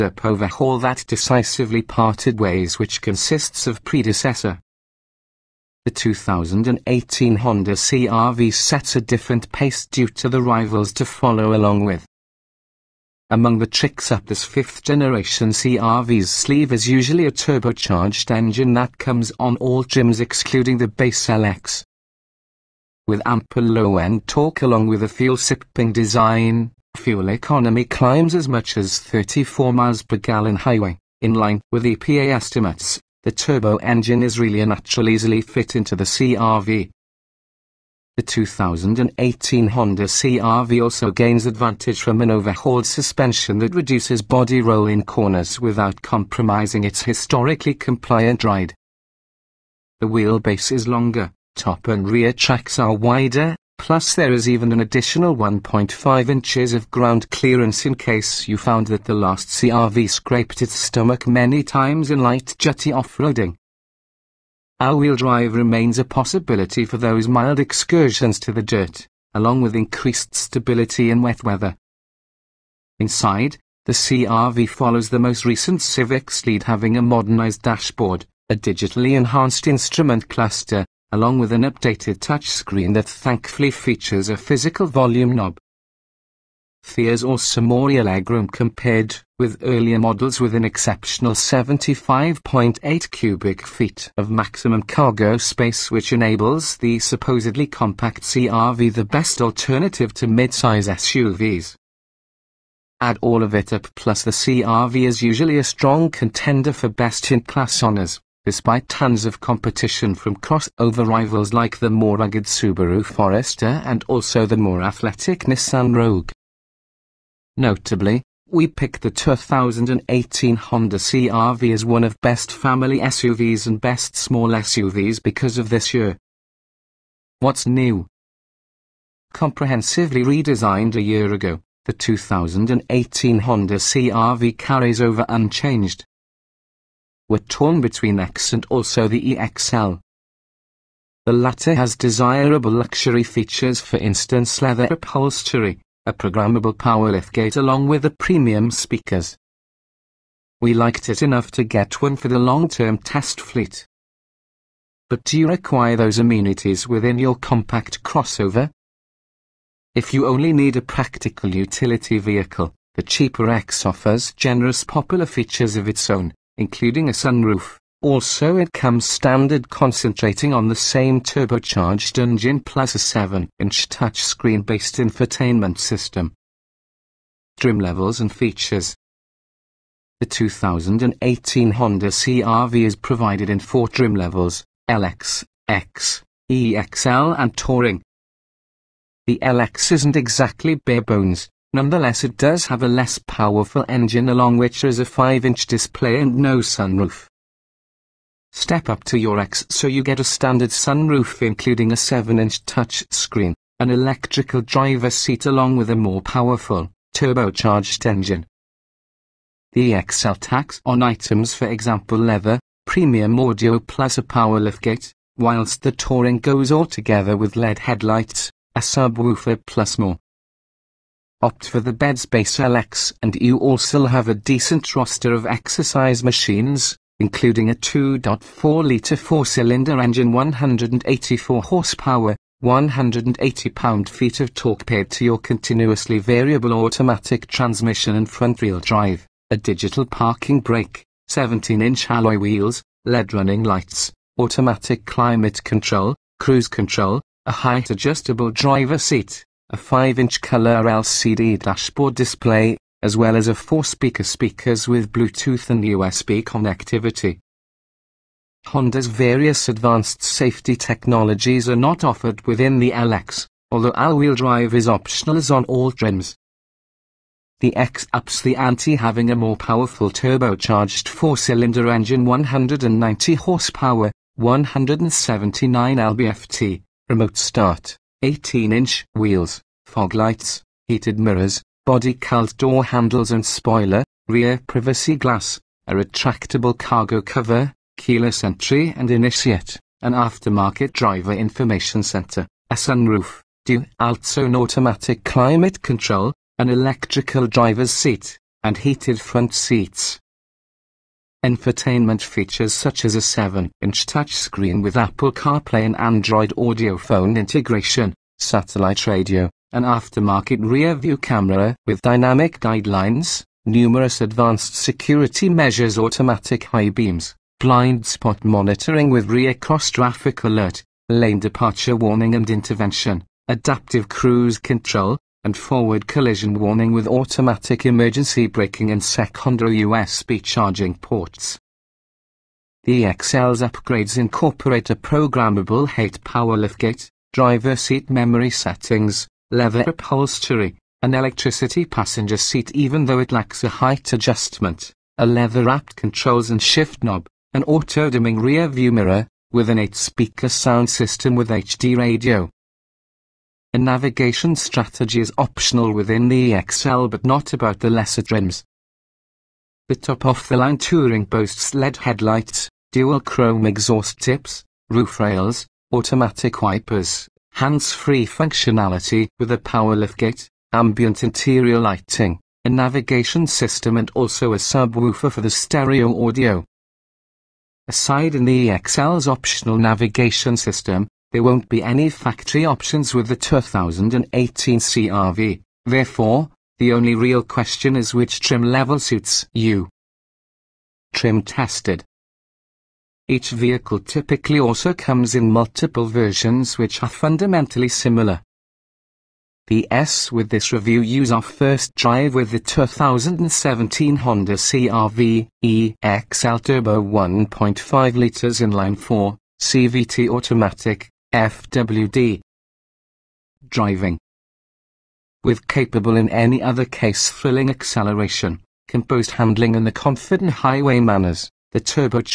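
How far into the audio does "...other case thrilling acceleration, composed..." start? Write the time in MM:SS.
06:56.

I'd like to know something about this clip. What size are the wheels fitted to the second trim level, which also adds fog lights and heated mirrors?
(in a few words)
18-inch.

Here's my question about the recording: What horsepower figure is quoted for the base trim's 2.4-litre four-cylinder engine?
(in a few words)
184.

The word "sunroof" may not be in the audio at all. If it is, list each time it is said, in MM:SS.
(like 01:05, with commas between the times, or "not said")
02:47, 03:16, 03:20, 04:52.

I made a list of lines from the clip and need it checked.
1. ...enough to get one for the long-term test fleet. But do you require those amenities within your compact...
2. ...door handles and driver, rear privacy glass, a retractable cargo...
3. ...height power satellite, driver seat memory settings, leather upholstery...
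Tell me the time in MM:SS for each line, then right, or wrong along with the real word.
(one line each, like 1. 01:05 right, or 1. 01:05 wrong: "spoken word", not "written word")
1. 02:31 right
2. 04:42 wrong: "spoiler", not "driver"
3. 05:35 wrong: "liftgate", not "satellite".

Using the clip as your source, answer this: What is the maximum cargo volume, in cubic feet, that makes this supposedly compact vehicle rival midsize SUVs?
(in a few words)
75.8 cubic feet.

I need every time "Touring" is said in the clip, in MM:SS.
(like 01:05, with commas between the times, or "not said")
03:07, 03:35, 06:00.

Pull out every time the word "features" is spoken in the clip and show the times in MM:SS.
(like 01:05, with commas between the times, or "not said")
01:23, 02:23, 02:45, 02:58, 05:02.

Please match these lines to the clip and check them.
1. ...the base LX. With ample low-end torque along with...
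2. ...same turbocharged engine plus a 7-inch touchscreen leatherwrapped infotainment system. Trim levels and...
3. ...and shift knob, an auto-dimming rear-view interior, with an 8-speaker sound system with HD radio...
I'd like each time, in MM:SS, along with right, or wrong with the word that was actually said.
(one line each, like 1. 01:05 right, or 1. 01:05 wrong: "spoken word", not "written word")
1. 00:20 right
2. 02:50 wrong: "based", not "leatherwrapped"
3. 05:46 wrong: "mirror", not "interior".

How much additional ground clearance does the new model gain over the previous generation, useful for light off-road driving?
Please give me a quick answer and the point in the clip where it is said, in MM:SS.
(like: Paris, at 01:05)
1.5 inches, at 00:55.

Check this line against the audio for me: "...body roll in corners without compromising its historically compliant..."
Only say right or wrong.
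right.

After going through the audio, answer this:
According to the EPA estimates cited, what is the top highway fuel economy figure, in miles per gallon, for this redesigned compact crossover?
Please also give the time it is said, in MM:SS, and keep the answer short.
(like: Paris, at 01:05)
34, at 00:28.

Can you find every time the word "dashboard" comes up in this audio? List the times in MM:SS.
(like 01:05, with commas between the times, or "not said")
01:17, 04:11.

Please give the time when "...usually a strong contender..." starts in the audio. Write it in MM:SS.
01:45.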